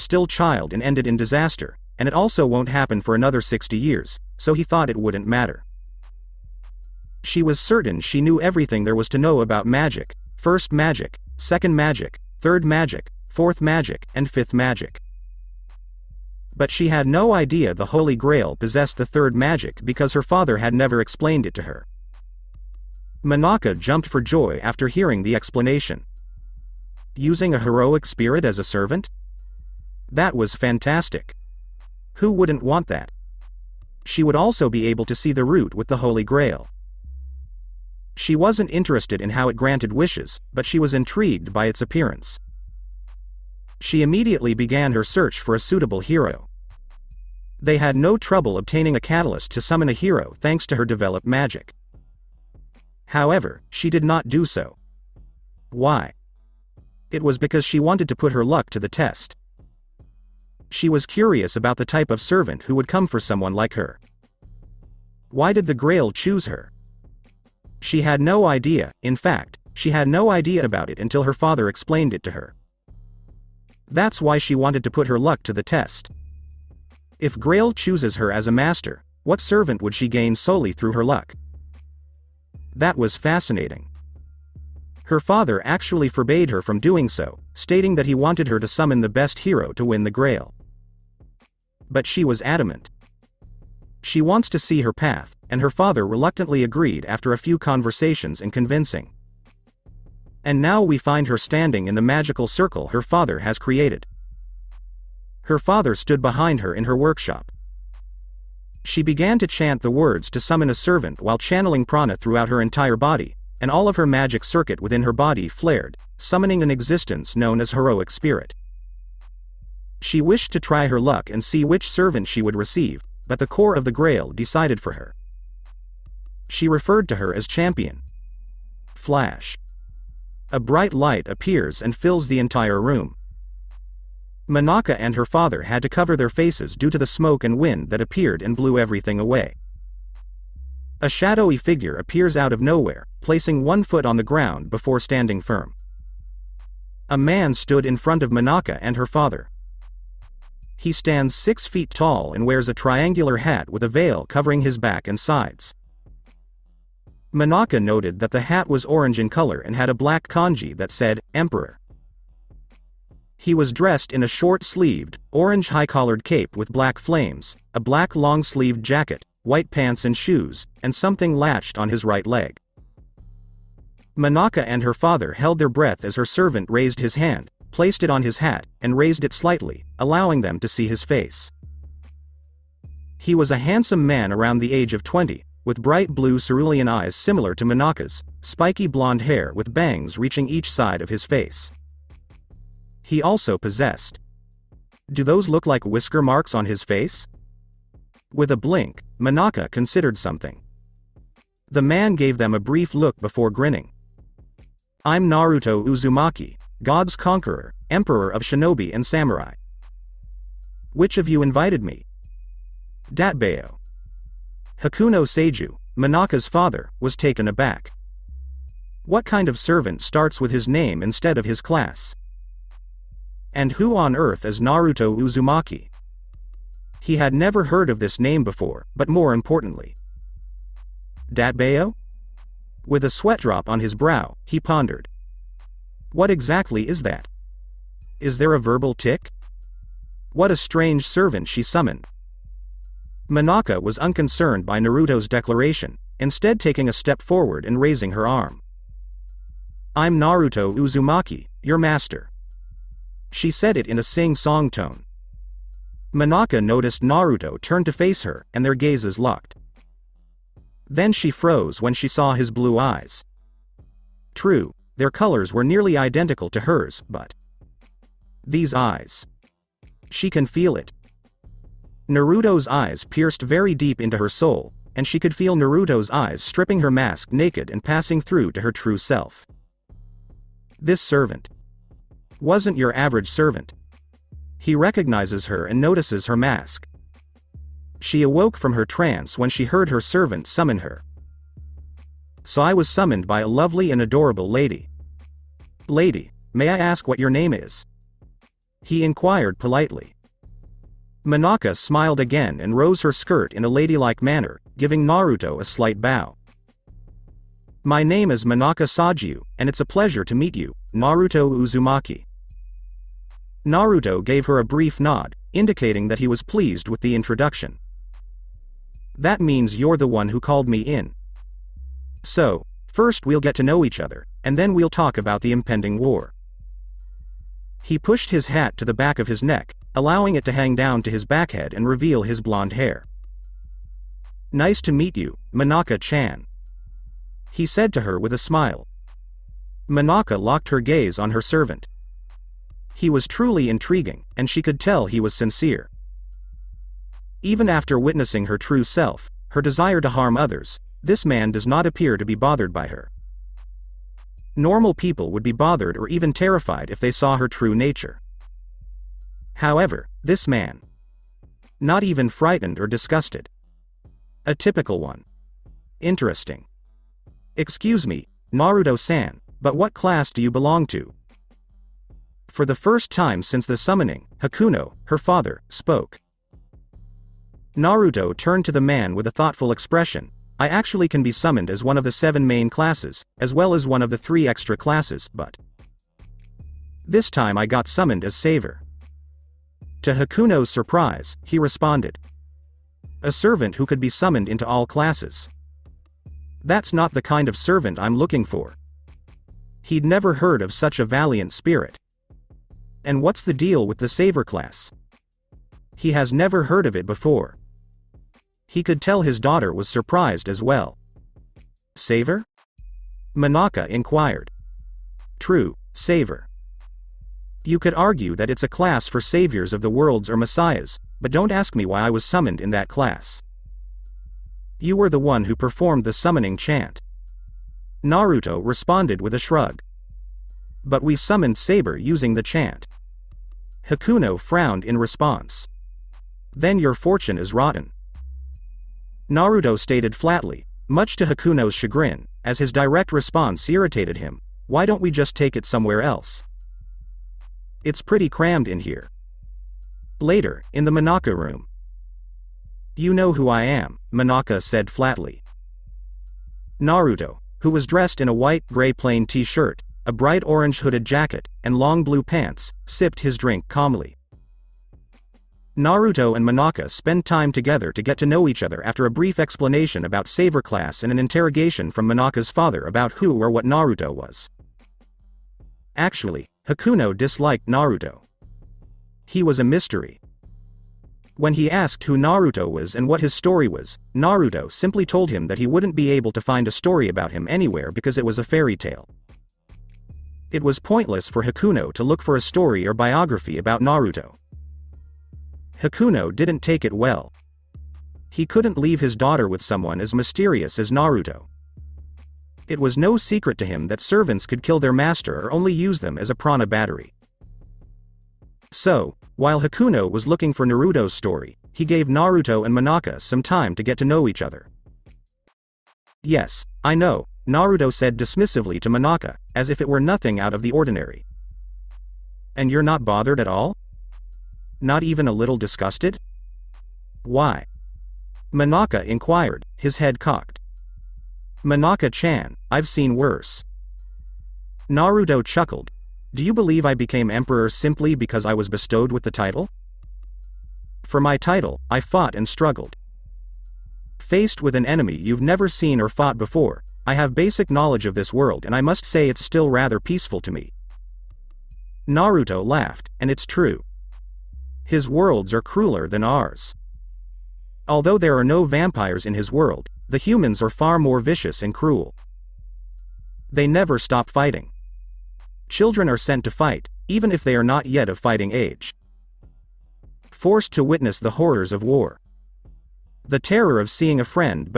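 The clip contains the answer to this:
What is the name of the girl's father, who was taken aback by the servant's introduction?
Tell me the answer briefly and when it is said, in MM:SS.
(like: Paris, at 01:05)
Hakuno Seiju, at 03:34.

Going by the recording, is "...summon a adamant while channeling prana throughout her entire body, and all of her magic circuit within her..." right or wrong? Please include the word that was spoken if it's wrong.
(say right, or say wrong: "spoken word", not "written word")
wrong: "servant", not "adamant".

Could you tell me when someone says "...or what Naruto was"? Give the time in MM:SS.
07:53.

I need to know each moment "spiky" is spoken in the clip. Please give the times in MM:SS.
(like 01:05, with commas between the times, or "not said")
03:08.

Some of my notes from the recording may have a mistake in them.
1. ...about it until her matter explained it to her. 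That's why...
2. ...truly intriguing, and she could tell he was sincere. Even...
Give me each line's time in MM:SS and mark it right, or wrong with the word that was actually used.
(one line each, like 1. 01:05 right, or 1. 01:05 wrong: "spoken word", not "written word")
1. 01:10 wrong: "father", not "matter"
2. 05:43 right.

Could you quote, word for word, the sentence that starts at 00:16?
But she had no idea the Holy Grail possessed the third magic because her father had never explained it to her.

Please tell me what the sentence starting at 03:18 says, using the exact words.
With a blink, Manaka considered something.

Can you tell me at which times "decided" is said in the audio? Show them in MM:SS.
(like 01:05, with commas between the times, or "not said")
02:04.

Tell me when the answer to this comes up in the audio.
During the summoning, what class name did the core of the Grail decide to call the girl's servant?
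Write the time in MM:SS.
02:07.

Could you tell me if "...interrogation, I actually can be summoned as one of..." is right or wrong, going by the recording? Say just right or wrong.
wrong.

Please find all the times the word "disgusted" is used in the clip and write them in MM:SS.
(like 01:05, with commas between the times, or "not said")
06:02, 08:45.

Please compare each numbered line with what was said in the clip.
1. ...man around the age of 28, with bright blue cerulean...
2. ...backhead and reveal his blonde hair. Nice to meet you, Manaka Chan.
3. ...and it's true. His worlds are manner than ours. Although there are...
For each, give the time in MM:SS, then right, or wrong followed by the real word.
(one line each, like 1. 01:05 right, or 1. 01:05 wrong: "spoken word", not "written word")
1. 03:04 wrong: "20", not "28"
2. 05:31 right
3. 09:13 wrong: "crueler", not "manner".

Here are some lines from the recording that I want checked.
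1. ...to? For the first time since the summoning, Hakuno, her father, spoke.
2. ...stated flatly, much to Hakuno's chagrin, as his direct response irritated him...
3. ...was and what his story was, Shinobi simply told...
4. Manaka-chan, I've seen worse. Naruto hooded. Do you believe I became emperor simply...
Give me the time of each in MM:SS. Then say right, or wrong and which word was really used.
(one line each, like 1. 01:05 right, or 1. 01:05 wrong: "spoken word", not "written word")
1. 06:10 right
2. 07:19 right
3. 08:02 wrong: "Naruto", not "Shinobi"
4. 08:51 wrong: "chuckled", not "hooded".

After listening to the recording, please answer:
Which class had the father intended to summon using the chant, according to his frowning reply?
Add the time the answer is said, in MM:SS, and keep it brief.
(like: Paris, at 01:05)
Saber, at 07:11.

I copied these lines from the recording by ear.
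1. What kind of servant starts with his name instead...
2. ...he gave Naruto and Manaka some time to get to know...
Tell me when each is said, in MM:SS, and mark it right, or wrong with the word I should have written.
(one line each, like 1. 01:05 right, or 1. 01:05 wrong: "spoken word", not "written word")
1. 03:39 right
2. 08:31 right.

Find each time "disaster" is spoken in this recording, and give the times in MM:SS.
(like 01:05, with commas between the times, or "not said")
00:01.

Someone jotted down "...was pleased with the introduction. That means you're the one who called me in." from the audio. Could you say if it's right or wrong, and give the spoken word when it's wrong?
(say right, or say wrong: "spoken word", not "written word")
right.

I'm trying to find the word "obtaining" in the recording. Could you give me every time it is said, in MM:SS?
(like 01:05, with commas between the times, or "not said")
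00:48.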